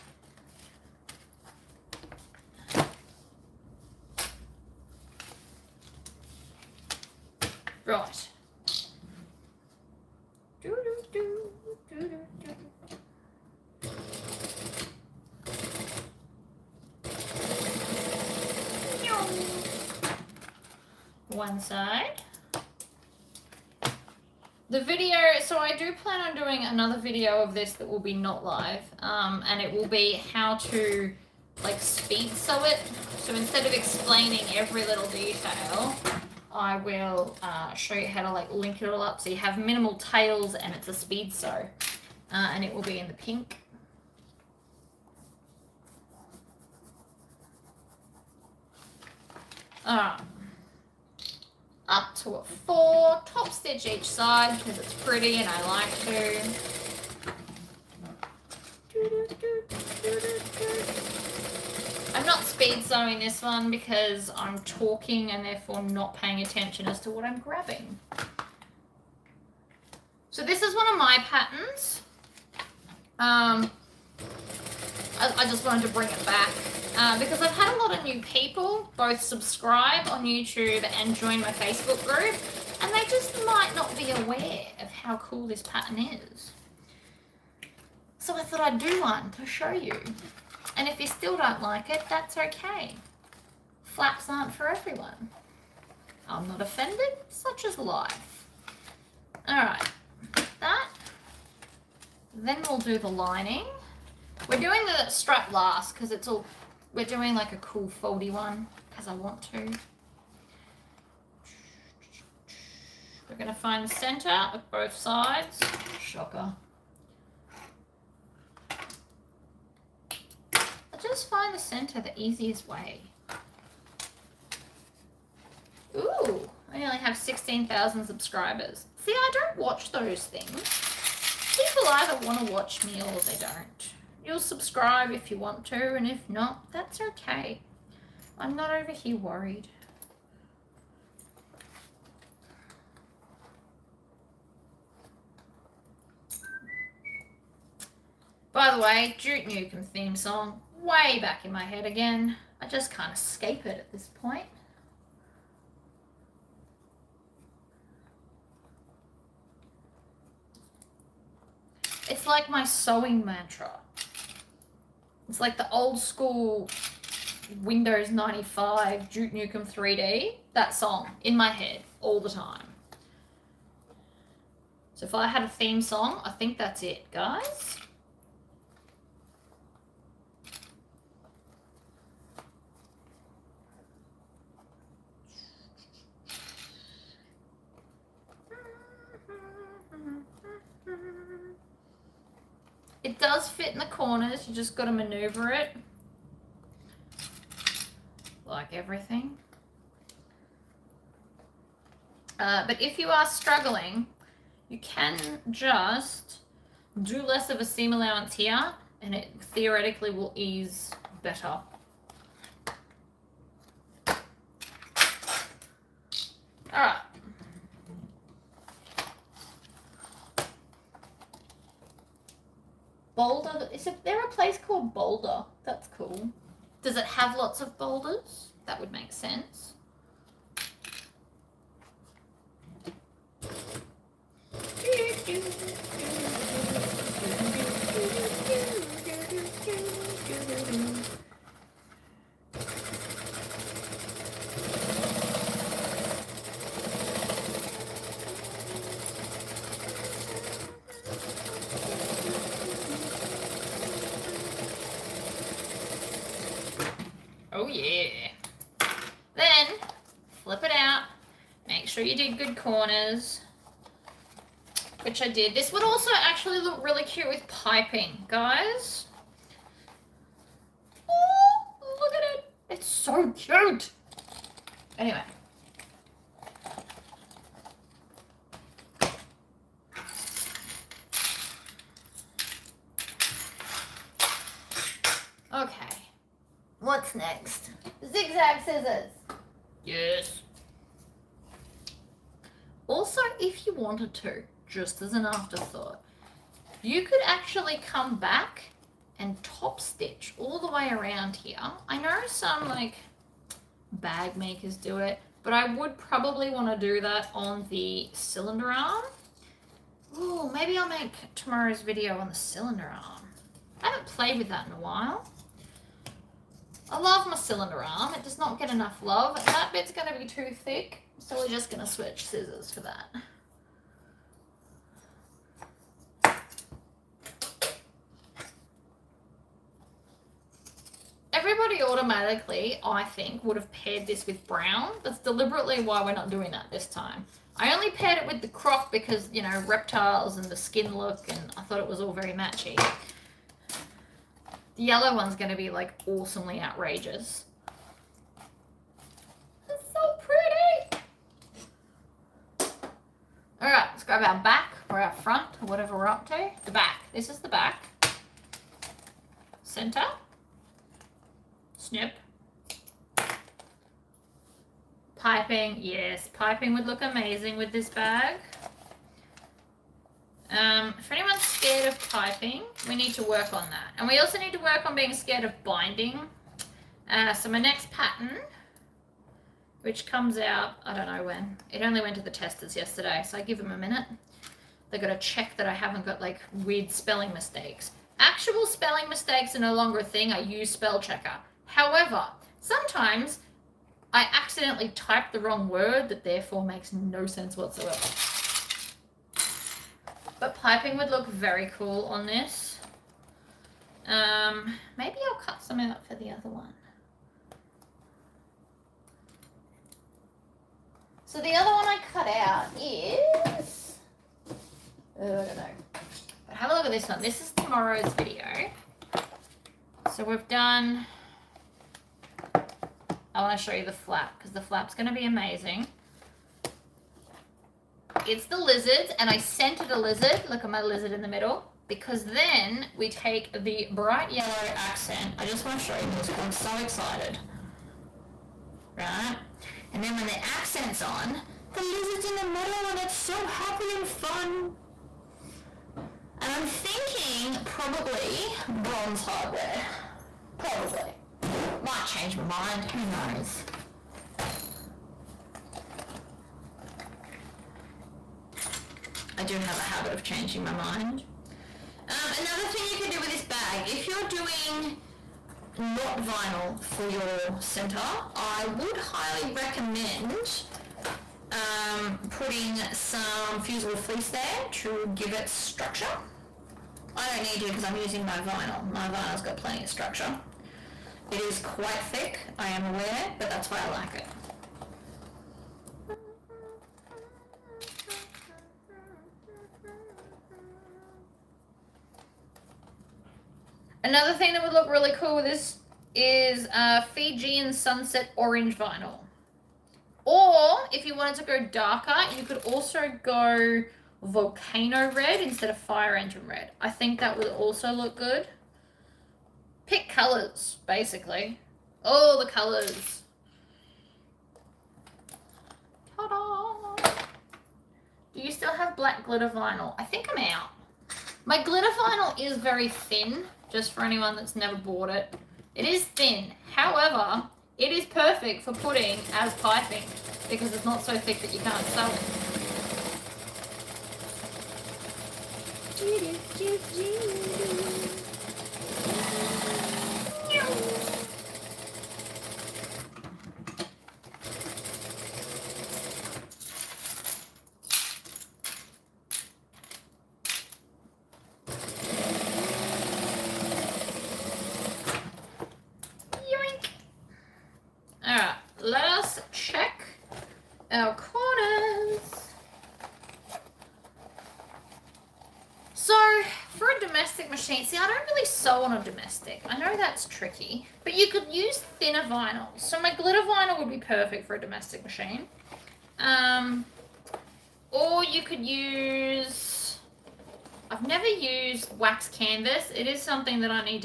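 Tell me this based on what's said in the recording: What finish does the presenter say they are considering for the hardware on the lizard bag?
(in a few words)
Bronze.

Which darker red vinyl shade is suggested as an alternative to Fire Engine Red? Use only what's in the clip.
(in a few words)
Volcano Red.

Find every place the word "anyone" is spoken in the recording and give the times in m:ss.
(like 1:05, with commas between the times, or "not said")
6:11, 8:44.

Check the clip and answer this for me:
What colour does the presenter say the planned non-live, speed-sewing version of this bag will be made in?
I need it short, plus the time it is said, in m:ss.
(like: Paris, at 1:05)
Pink, at 0:43.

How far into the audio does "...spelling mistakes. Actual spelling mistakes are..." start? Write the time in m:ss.
6:26.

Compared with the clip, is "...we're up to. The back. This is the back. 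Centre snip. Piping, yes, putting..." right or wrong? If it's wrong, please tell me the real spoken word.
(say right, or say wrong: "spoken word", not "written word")
wrong: "piping", not "putting".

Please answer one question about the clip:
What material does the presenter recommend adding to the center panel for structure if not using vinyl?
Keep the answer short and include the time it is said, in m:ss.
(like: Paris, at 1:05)
Fusible fleece, at 7:53.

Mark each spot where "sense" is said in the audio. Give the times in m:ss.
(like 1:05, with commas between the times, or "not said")
3:49, 6:37.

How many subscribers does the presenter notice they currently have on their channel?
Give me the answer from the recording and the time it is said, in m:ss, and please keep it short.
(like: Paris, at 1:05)
16,000, at 2:07.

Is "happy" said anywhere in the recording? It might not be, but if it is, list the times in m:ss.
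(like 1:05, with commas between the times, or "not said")
7:23.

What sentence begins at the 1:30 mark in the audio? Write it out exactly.
And if you still don't like it, that's okay.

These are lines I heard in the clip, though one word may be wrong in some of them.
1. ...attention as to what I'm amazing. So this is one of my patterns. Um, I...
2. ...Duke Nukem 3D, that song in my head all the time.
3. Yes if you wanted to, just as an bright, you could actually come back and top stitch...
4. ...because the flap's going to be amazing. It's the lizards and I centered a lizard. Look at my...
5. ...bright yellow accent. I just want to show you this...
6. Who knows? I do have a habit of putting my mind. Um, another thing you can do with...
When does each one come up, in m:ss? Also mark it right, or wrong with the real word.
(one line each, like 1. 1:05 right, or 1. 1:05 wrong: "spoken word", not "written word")
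1. 1:06 wrong: "grabbing", not "amazing"
2. 2:49 right
3. 4:49 wrong: "afterthought", not "bright"
4. 7:04 right
5. 7:13 right
6. 7:32 wrong: "changing", not "putting".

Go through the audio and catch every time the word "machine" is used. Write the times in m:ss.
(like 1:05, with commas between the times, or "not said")
9:35.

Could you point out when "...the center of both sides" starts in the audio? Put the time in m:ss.
1:53.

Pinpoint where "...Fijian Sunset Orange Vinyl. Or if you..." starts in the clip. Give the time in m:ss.
8:17.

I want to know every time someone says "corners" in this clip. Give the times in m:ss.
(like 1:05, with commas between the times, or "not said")
3:13, 4:22.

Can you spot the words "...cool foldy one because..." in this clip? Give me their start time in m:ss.
1:47.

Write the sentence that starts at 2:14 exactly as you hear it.
You'll subscribe if you want to, and if not, that's okay.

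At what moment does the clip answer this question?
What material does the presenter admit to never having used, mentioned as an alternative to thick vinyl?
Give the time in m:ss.
9:41.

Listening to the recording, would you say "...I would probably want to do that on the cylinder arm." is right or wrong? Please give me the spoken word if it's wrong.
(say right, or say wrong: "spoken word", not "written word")
right.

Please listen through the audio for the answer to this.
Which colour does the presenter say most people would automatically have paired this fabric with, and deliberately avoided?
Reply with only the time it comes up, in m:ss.
5:34.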